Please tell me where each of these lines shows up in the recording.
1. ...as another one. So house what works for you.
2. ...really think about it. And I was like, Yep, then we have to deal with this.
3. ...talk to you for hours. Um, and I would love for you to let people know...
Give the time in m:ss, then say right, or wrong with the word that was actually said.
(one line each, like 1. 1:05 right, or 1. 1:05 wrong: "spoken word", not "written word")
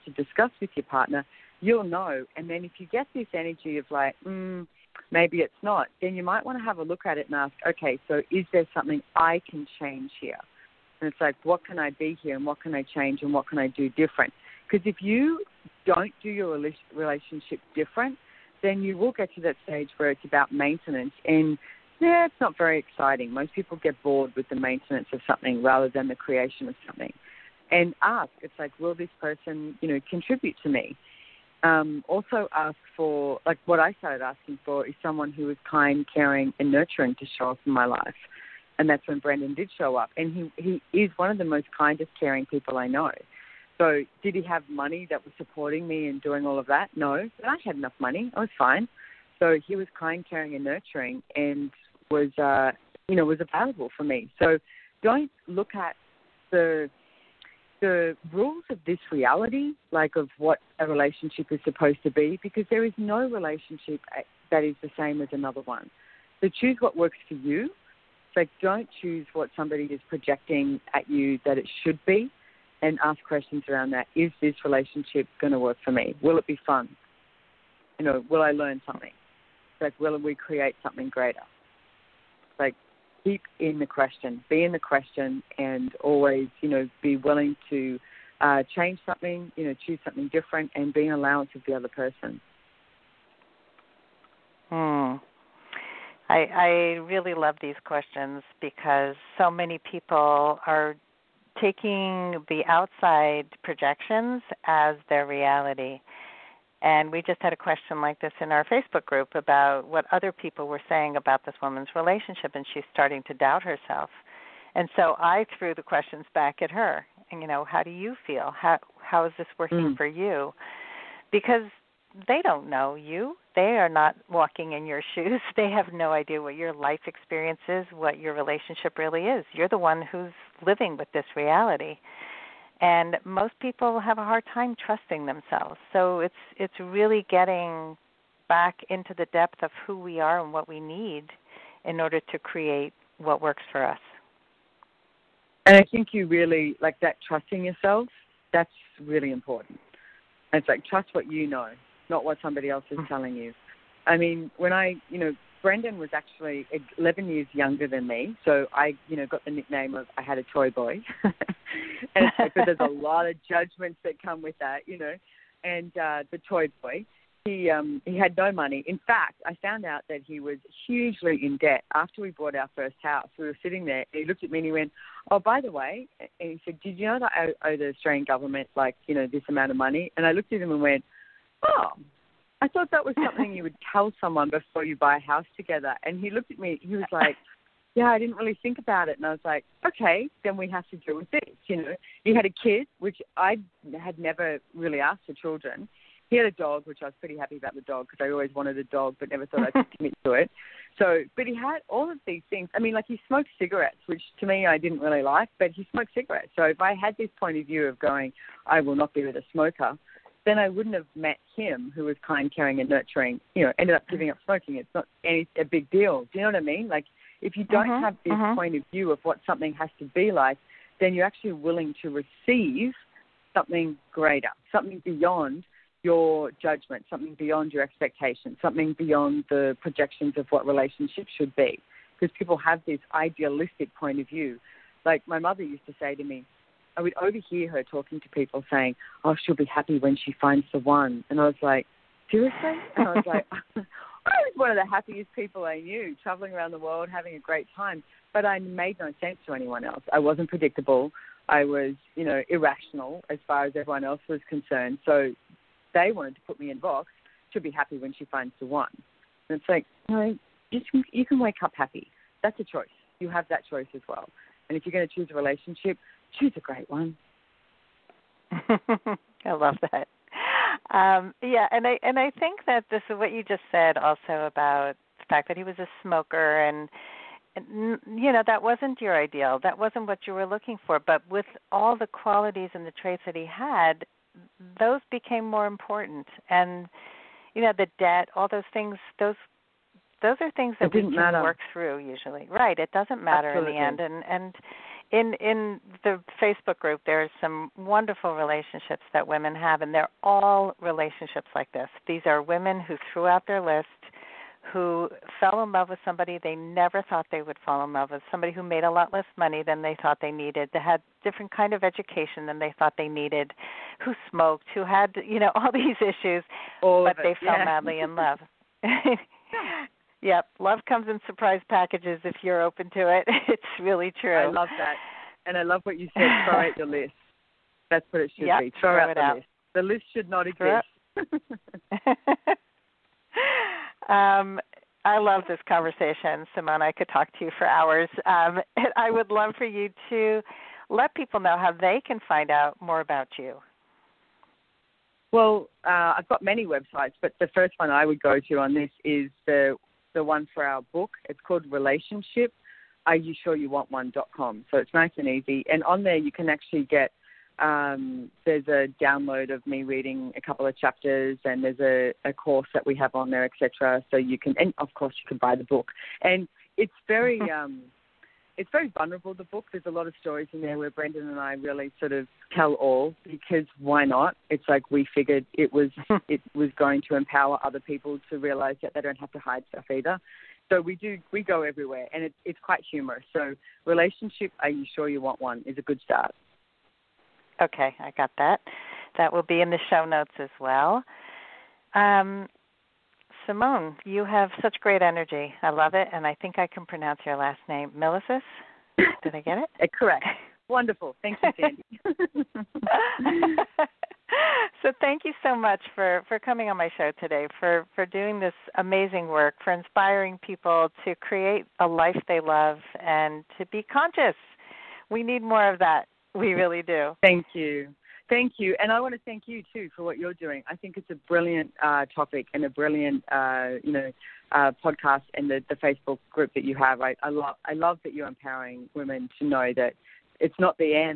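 1. 1:05 wrong: "choose", not "house"
2. 3:08 wrong: "Okay", not "Yep"
3. 5:37 right.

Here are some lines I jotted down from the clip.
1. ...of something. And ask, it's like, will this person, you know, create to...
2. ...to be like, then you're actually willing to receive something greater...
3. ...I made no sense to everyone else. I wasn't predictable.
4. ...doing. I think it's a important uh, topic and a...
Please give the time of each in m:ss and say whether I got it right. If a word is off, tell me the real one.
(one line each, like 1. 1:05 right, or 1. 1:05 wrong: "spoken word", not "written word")
1. 0:26 wrong: "contribute", not "create"
2. 3:39 right
3. 4:08 wrong: "anyone", not "everyone"
4. 7:00 wrong: "brilliant", not "important".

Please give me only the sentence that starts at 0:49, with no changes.
So, he was kind, caring, and nurturing and was, uh, you know, was available for me.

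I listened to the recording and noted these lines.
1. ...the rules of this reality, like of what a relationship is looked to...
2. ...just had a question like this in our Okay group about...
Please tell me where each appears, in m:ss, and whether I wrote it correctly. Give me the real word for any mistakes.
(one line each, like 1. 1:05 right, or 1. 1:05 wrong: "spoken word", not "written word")
1. 0:57 wrong: "supposed", not "looked"
2. 1:47 wrong: "Facebook", not "Okay".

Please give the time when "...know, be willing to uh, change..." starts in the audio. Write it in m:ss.
1:26.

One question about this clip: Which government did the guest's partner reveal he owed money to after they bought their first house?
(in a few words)
Australian government.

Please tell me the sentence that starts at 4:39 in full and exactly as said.
That wasn't what you were looking for.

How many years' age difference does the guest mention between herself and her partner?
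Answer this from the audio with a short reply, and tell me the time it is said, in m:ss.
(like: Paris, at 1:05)
11, at 2:36.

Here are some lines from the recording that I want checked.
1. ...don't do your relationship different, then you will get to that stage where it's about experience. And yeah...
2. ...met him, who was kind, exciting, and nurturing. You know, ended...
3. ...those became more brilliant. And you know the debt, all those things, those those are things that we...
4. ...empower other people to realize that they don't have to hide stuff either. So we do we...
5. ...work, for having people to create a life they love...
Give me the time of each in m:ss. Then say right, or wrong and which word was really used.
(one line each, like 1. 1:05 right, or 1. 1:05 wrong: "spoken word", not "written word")
1. 0:15 wrong: "maintenance", not "experience"
2. 3:31 wrong: "caring", not "exciting"
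3. 4:44 wrong: "important", not "brilliant"
4. 6:17 right
5. 6:49 wrong: "inspiring", not "having".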